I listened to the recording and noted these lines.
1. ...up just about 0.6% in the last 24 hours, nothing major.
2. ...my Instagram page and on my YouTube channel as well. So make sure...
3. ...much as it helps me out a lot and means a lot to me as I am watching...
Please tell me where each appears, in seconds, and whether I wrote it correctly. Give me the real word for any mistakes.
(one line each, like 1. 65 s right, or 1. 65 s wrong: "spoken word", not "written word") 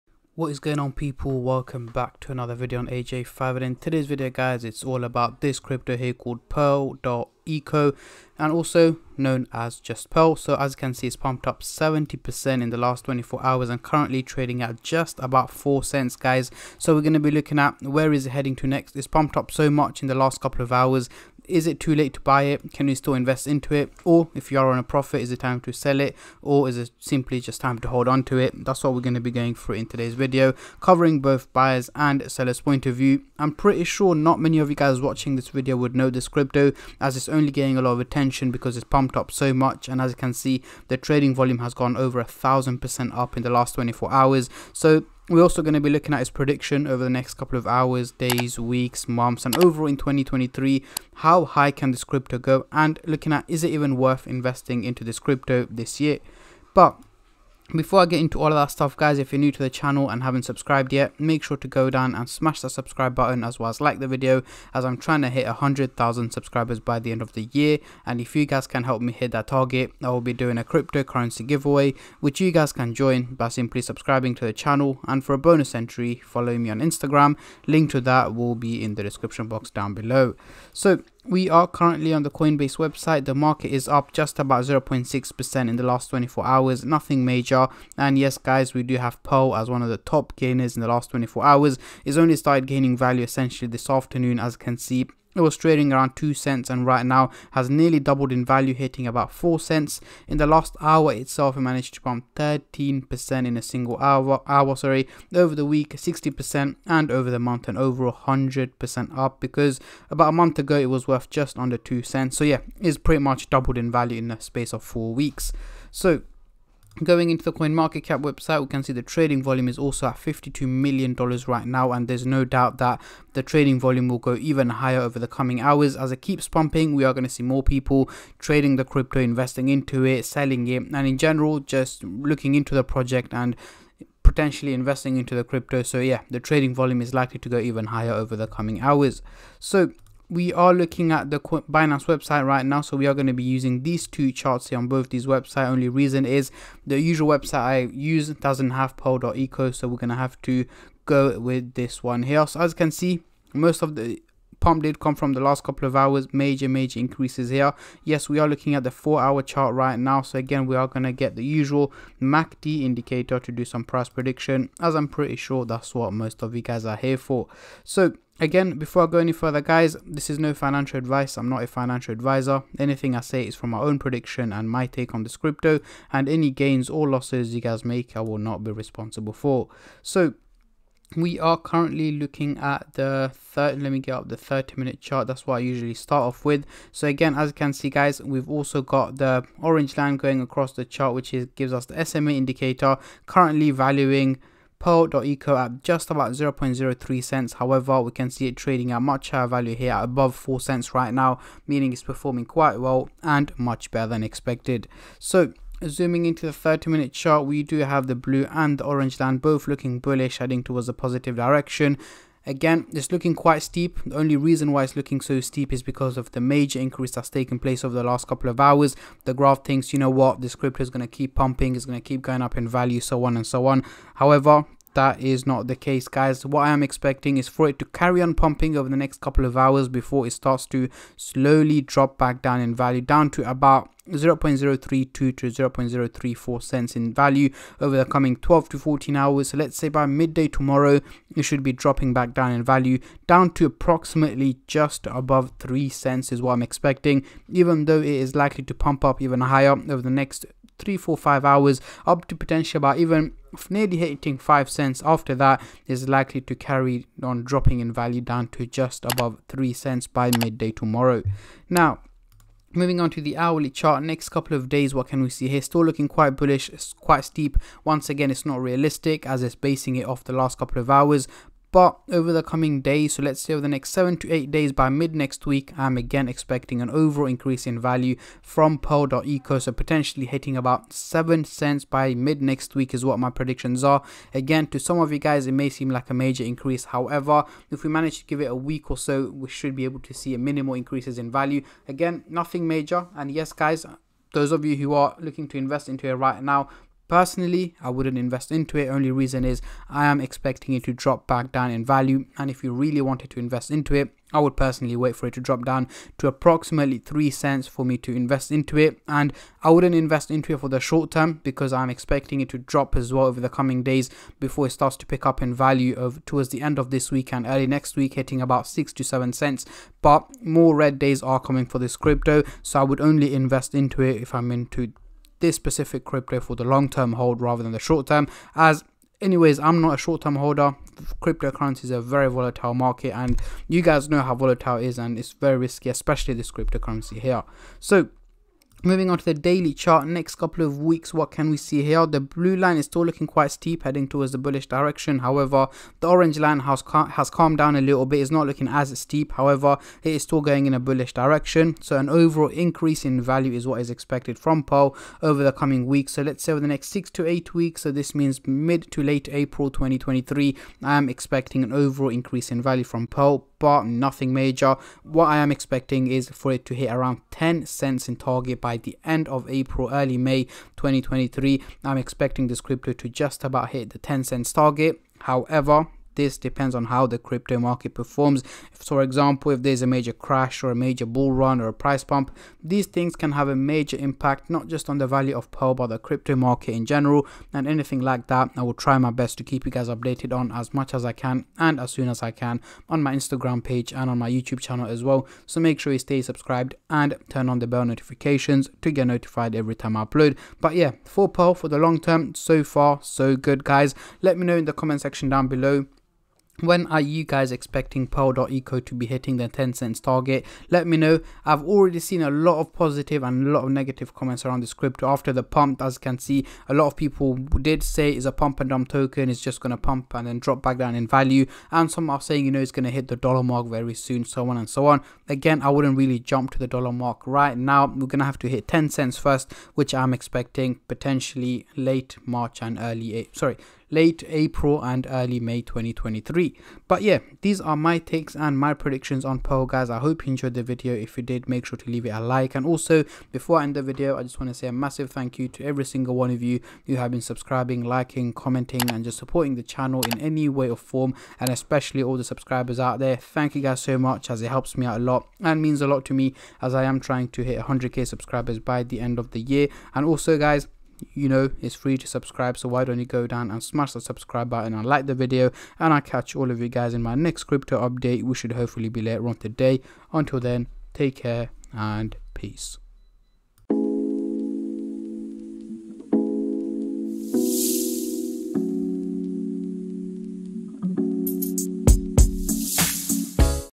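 1. 83 s right
2. 393 s right
3. 453 s wrong: "trying", not "watching".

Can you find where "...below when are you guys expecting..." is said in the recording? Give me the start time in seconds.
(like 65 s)
405 s.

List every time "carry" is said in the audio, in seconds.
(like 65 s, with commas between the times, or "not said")
227 s, 256 s.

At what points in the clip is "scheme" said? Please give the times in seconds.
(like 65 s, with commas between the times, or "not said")
not said.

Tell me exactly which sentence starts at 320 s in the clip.
But more red days are coming for this crypto.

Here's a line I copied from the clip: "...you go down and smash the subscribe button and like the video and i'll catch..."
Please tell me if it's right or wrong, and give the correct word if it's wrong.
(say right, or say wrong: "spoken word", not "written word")
right.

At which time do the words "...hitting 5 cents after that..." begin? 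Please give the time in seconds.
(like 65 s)
253 s.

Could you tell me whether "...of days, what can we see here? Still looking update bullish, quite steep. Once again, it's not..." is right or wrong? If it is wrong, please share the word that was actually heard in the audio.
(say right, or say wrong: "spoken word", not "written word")
wrong: "quite", not "update".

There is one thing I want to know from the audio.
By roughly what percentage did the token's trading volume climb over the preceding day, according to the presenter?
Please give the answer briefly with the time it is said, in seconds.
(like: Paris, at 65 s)
over 1000%, at 41 s.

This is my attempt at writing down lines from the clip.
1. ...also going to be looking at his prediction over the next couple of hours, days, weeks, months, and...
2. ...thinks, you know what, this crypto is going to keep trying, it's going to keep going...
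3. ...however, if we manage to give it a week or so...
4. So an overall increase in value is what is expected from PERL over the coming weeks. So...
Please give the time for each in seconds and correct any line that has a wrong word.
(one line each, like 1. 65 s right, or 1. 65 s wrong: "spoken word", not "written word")
1. 45 s right
2. 219 s wrong: "pumping", not "trying"
3. 286 s right
4. 351 s right.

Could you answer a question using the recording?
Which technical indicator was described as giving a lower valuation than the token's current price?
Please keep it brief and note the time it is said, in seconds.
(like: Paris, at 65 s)
SMA, at 192 s.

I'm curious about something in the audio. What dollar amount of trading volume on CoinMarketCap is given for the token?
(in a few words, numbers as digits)
$52 million.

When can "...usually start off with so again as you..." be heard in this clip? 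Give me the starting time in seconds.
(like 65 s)
185 s.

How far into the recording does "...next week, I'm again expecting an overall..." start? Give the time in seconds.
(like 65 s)
275 s.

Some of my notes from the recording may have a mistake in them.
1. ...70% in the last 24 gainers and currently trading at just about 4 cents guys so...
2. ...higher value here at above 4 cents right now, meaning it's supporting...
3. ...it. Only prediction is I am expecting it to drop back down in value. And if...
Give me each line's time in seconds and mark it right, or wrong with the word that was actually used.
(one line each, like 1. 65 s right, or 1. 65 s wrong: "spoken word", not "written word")
1. 11 s wrong: "hours", not "gainers"
2. 199 s wrong: "performing", not "supporting"
3. 298 s wrong: "reason", not "prediction".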